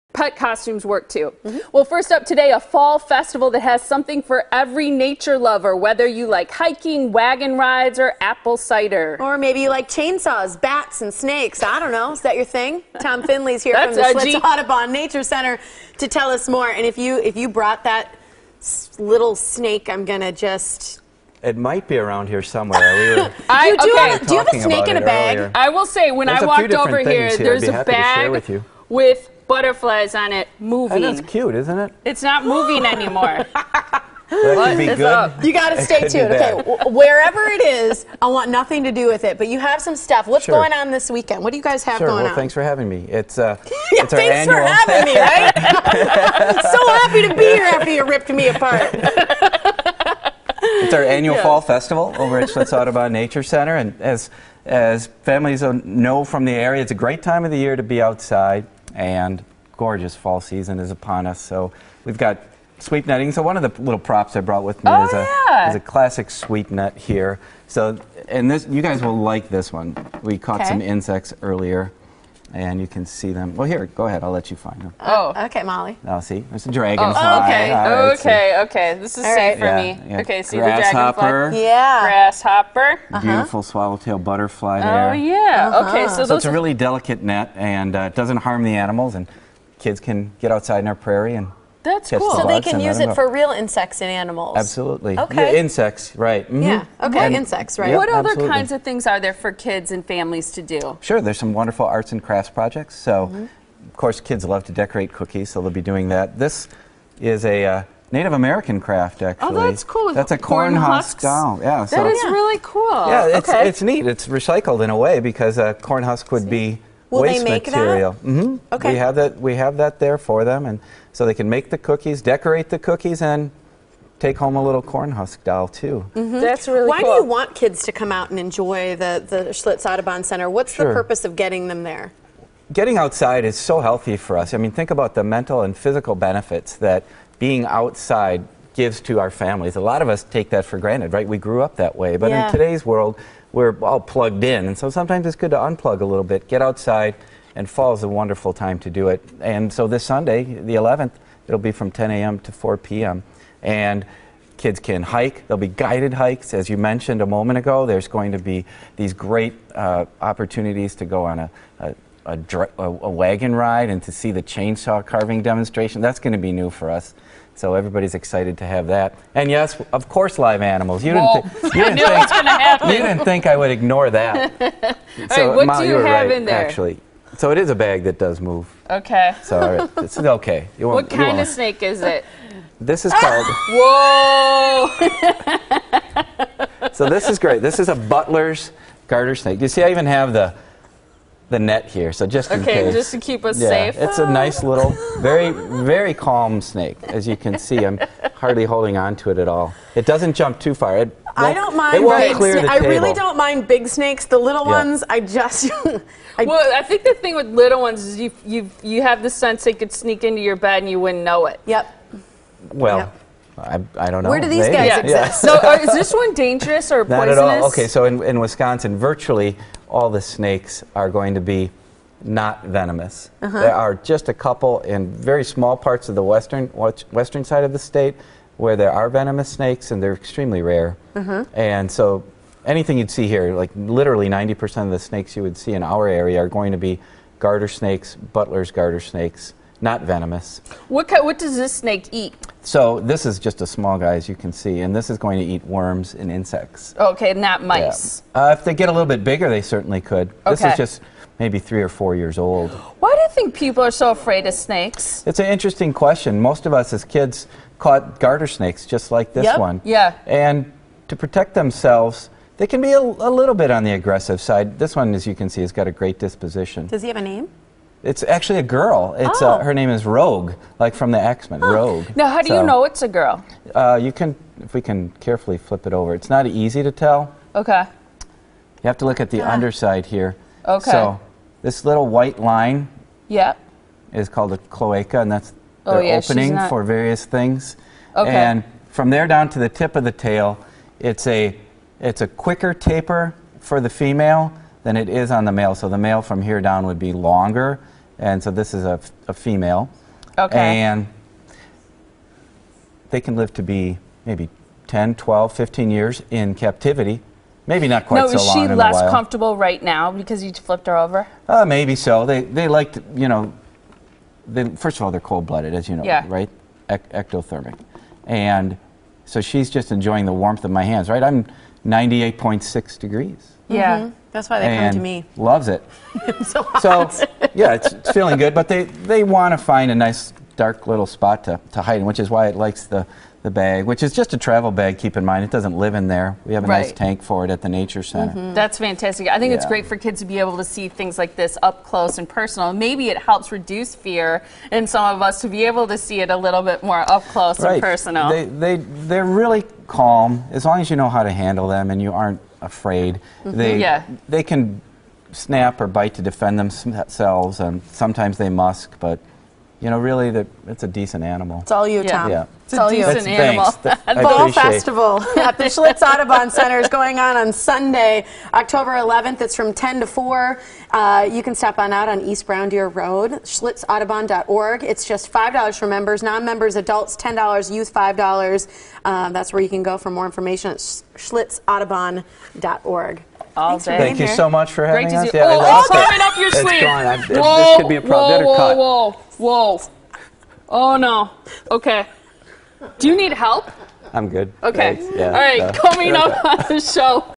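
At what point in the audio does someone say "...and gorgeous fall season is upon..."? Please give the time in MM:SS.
00:58.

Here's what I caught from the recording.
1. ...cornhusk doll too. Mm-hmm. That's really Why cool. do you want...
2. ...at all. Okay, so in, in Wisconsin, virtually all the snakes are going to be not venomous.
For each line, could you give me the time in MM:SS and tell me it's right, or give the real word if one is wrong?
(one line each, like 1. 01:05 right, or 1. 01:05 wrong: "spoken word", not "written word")
1. 02:04 right
2. 03:37 right.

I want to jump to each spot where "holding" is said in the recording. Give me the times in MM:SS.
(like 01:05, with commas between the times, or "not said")
03:18.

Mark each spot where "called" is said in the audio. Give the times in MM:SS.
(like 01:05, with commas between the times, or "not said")
03:03, 04:44.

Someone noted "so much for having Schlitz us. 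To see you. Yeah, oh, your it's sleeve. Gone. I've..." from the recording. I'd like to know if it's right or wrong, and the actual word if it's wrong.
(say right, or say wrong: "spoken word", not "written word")
wrong: "Great", not "Schlitz".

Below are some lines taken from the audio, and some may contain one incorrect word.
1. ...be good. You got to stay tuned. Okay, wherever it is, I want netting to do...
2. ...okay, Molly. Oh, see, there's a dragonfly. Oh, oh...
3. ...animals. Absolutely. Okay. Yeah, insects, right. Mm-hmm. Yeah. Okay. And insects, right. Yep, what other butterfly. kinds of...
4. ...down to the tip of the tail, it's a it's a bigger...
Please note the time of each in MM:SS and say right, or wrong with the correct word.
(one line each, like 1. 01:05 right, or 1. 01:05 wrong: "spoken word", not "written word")
1. 00:34 wrong: "nothing", not "netting"
2. 01:15 right
3. 01:34 wrong: "absolutely", not "butterfly"
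4. 04:49 wrong: "quicker", not "bigger".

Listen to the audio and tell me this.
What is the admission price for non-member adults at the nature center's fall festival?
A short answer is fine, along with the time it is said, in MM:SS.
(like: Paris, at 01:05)
$10, at 06:16.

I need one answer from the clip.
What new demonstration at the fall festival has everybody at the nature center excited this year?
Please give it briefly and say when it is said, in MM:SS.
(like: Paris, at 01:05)
Chainsaw carving, at 02:44.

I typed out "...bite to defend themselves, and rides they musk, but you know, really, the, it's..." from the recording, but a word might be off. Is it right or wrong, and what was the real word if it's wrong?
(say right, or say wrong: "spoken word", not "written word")
wrong: "sometimes", not "rides".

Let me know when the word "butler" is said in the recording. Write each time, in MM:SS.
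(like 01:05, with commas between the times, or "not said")
03:07, 03:58.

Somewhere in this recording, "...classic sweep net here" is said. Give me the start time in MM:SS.
01:05.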